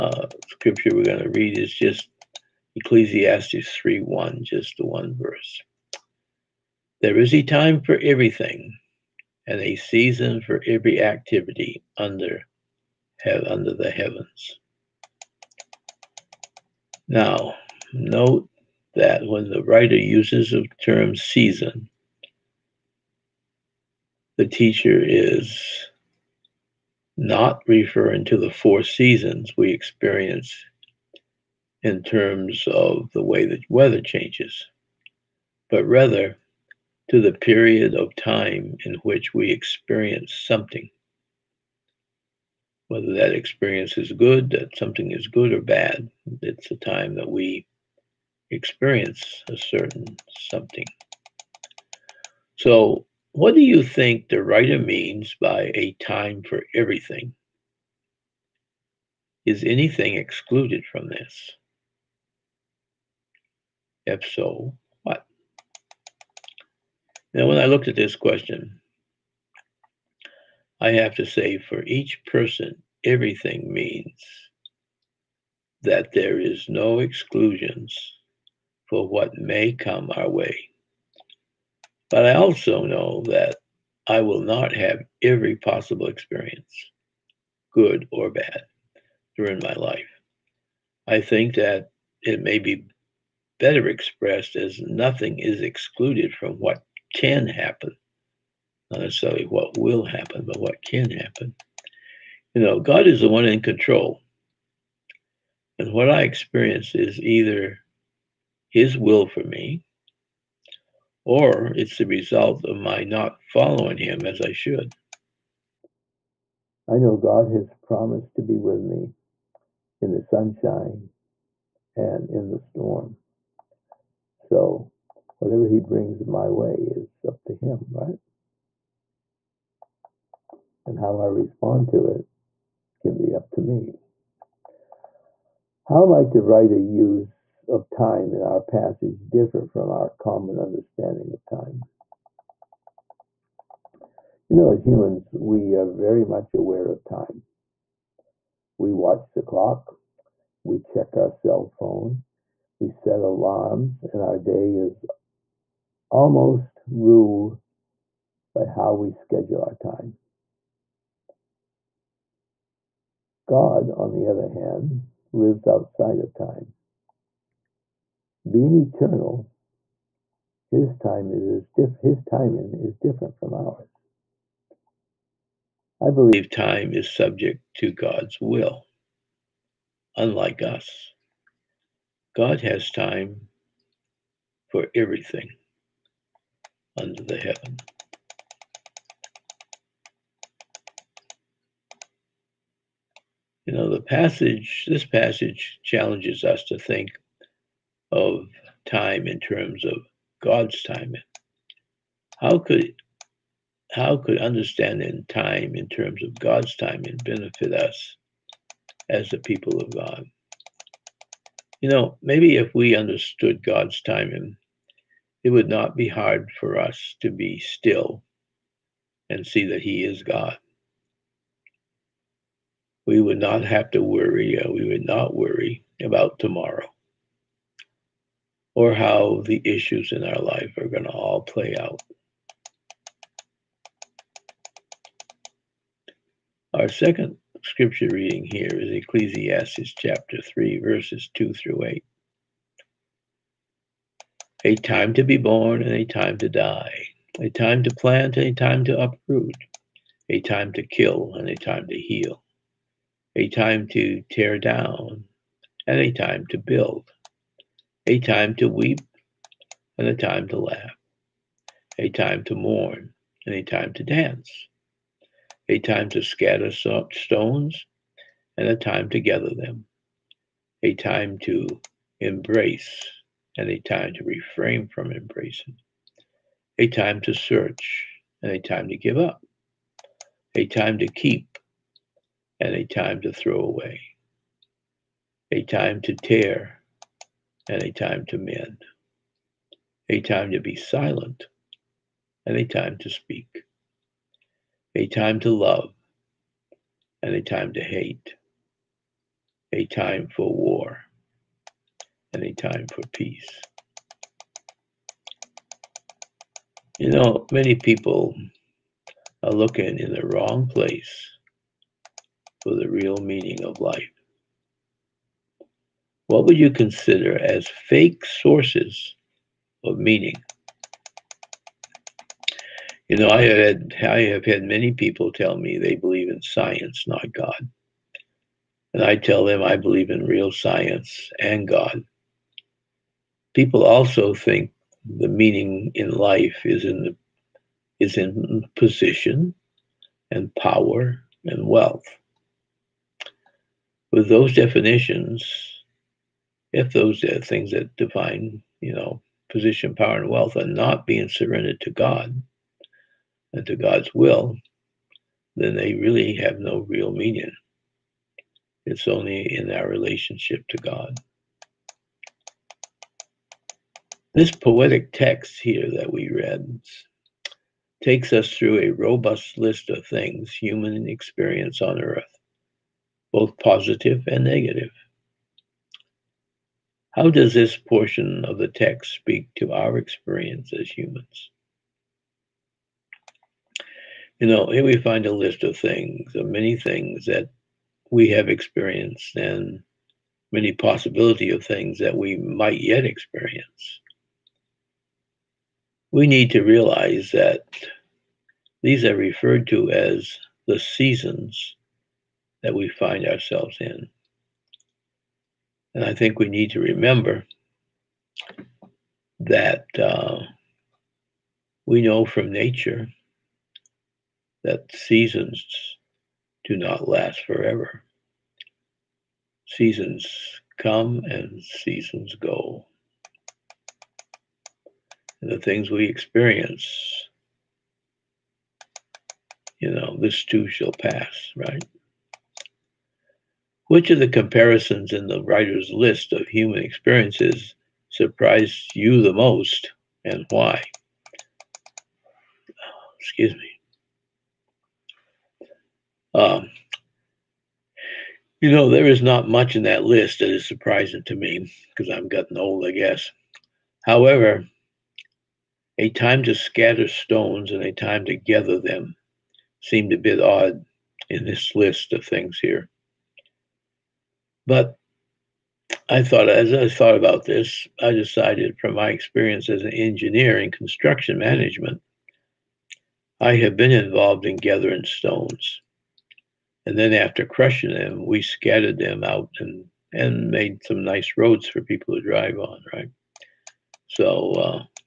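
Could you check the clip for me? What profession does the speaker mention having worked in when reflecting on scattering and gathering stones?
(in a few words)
engineer.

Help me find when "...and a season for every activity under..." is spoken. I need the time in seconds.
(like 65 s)
9 s.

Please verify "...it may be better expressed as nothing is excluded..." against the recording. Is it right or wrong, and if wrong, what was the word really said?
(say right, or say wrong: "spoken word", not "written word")
right.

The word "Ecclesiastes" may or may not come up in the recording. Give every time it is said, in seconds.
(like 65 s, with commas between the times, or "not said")
2 s, 238 s.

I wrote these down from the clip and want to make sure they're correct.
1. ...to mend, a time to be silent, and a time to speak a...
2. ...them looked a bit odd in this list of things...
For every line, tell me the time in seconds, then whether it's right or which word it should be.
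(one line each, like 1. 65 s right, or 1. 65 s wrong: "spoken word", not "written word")
1. 288 s right
2. 458 s wrong: "seemed", not "looked".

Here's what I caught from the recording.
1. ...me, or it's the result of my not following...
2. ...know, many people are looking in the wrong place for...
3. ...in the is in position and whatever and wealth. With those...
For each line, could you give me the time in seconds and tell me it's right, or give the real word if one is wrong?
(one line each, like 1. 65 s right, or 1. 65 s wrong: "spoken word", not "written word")
1. 109 s right
2. 307 s right
3. 336 s wrong: "power", not "whatever".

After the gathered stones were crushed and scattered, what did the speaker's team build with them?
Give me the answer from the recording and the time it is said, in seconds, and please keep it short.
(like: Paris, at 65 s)
roads, at 481 s.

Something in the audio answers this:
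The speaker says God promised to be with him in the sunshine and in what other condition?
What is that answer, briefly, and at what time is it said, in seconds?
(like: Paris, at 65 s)
the storm, at 122 s.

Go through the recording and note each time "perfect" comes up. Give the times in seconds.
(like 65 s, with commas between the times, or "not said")
not said.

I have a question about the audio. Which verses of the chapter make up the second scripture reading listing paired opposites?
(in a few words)
2 through 8.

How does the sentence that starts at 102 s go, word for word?
You know, God is the one in control.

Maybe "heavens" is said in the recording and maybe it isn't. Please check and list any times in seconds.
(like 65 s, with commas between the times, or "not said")
13 s, 187 s.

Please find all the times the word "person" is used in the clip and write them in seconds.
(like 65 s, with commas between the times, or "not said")
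72 s.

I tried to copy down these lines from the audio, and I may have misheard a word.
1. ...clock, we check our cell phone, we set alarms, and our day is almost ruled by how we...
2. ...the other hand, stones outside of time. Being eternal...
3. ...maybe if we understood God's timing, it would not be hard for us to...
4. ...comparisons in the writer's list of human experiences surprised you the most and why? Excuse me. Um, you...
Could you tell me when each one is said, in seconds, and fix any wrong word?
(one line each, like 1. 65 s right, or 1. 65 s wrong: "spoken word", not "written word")
1. 149 s right
2. 164 s wrong: "lives", not "stones"
3. 212 s right
4. 434 s right.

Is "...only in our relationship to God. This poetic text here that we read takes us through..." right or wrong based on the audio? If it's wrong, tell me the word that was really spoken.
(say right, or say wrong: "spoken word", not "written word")
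right.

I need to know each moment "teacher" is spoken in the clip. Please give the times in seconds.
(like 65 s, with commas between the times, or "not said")
24 s.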